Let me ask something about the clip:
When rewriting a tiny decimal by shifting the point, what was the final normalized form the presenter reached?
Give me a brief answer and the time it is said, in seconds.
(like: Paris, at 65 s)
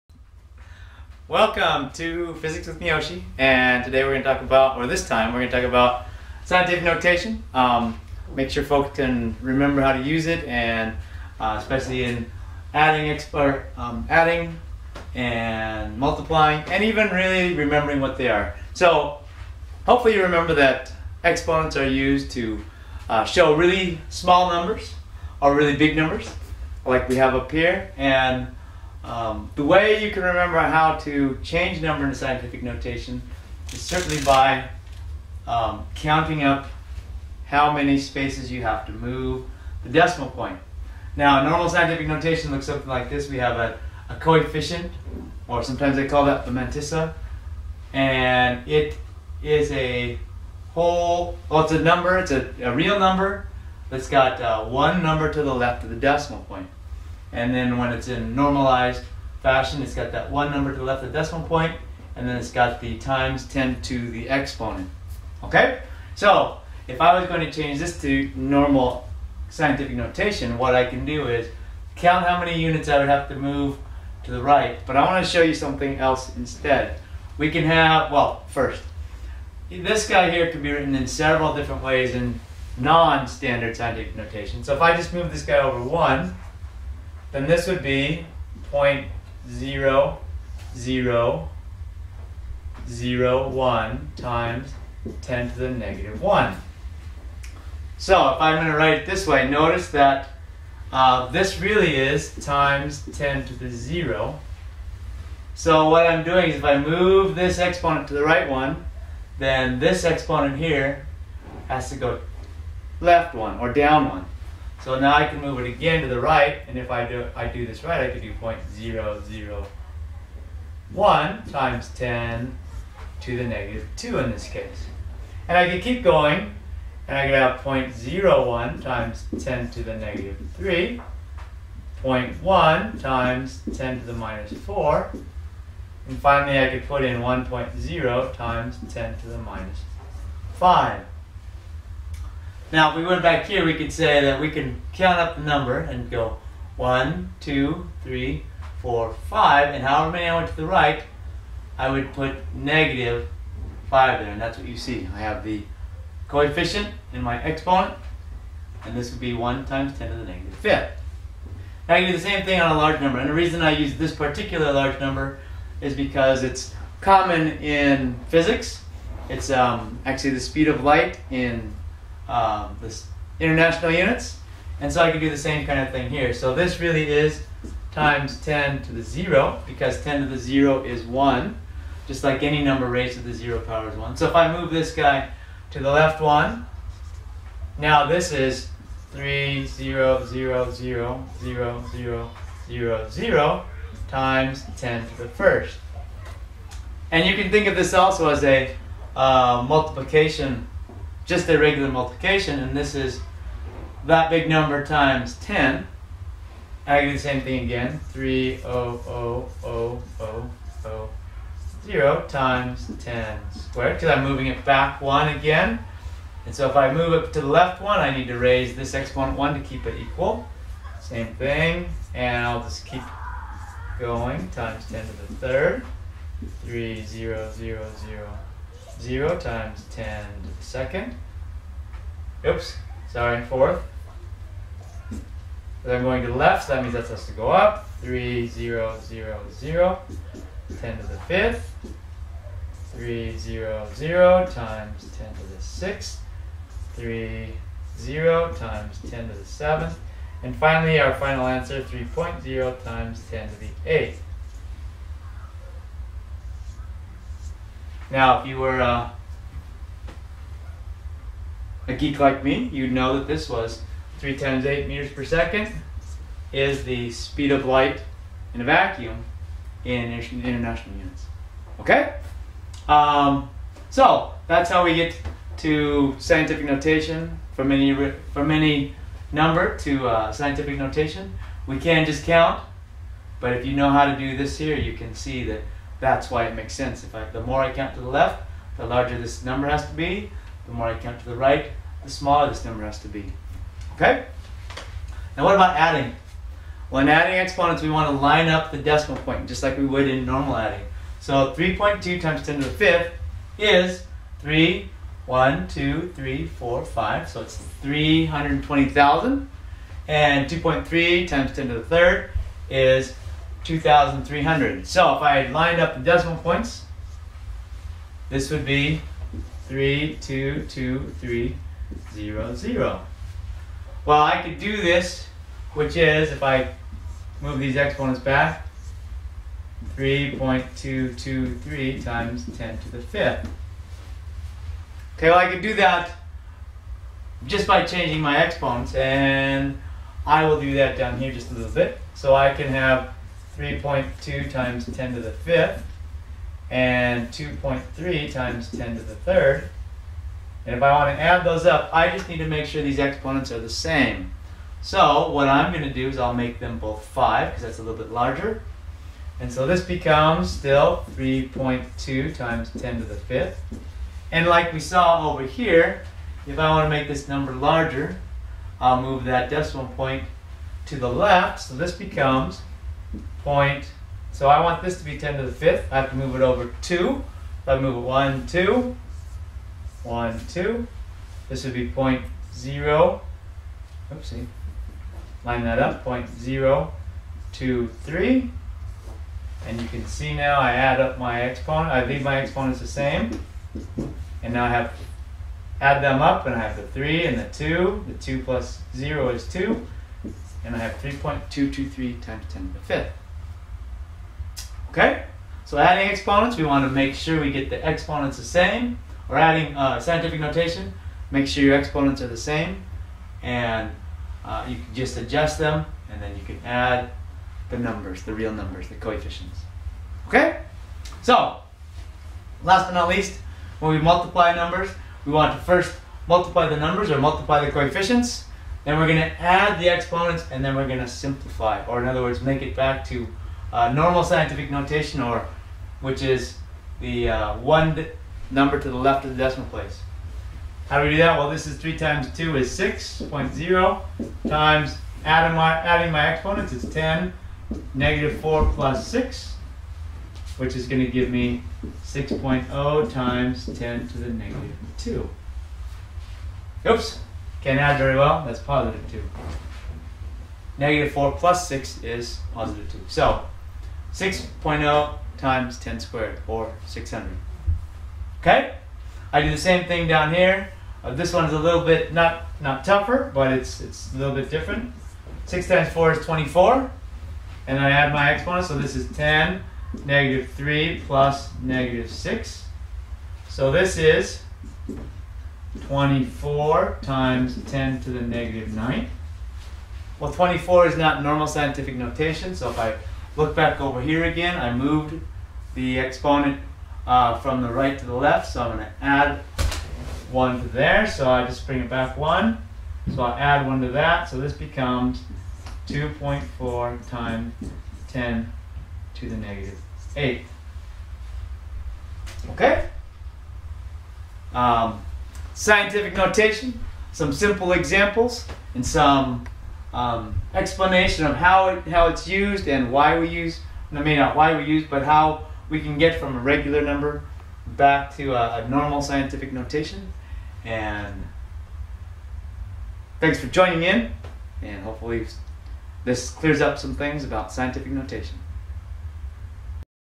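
1.0 times 10 to the minus 5, at 137 s.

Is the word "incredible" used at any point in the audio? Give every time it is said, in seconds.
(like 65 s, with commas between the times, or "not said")
not said.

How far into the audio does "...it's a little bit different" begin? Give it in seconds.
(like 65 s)
473 s.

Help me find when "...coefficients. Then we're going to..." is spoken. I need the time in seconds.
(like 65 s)
427 s.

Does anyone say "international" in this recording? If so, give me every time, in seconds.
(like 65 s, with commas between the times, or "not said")
173 s, 270 s.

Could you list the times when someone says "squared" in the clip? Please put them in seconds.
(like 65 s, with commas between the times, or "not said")
213 s, 465 s.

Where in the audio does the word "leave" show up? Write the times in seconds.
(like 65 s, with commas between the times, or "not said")
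392 s.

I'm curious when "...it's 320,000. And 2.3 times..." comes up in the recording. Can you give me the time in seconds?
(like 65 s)
307 s.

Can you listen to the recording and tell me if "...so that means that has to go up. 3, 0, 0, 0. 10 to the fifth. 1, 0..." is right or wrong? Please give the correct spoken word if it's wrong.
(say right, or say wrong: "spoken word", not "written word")
wrong: "3", not "1".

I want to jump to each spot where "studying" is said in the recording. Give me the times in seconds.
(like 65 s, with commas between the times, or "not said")
not said.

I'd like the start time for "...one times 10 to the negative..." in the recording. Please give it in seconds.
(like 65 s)
159 s.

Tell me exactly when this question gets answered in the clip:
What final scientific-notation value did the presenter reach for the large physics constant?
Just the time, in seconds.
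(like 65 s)
251 s.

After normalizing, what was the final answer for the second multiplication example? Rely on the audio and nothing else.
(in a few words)
2.4 times 10 to the negative 8.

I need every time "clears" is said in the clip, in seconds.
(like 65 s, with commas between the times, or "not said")
536 s.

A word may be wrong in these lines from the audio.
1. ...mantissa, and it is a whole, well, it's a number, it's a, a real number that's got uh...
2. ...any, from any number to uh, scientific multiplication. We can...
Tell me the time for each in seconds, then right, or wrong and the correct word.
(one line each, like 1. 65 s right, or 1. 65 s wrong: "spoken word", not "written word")
1. 46 s right
2. 277 s wrong: "notation", not "multiplication".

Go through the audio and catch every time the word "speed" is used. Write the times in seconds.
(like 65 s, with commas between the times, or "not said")
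170 s, 267 s.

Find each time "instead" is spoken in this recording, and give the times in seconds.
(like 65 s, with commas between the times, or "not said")
76 s.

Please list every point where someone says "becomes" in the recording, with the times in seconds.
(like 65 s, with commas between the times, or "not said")
359 s, 371 s, 504 s.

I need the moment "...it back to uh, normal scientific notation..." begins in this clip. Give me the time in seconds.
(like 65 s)
432 s.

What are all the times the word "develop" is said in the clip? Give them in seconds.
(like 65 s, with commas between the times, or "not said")
not said.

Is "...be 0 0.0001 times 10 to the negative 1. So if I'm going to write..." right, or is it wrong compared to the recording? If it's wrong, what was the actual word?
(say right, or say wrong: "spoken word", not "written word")
right.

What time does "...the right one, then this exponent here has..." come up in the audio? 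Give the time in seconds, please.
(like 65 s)
108 s.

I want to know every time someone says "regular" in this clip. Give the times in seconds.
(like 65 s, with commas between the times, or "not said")
201 s, 526 s.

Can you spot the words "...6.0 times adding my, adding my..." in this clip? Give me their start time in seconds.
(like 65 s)
442 s.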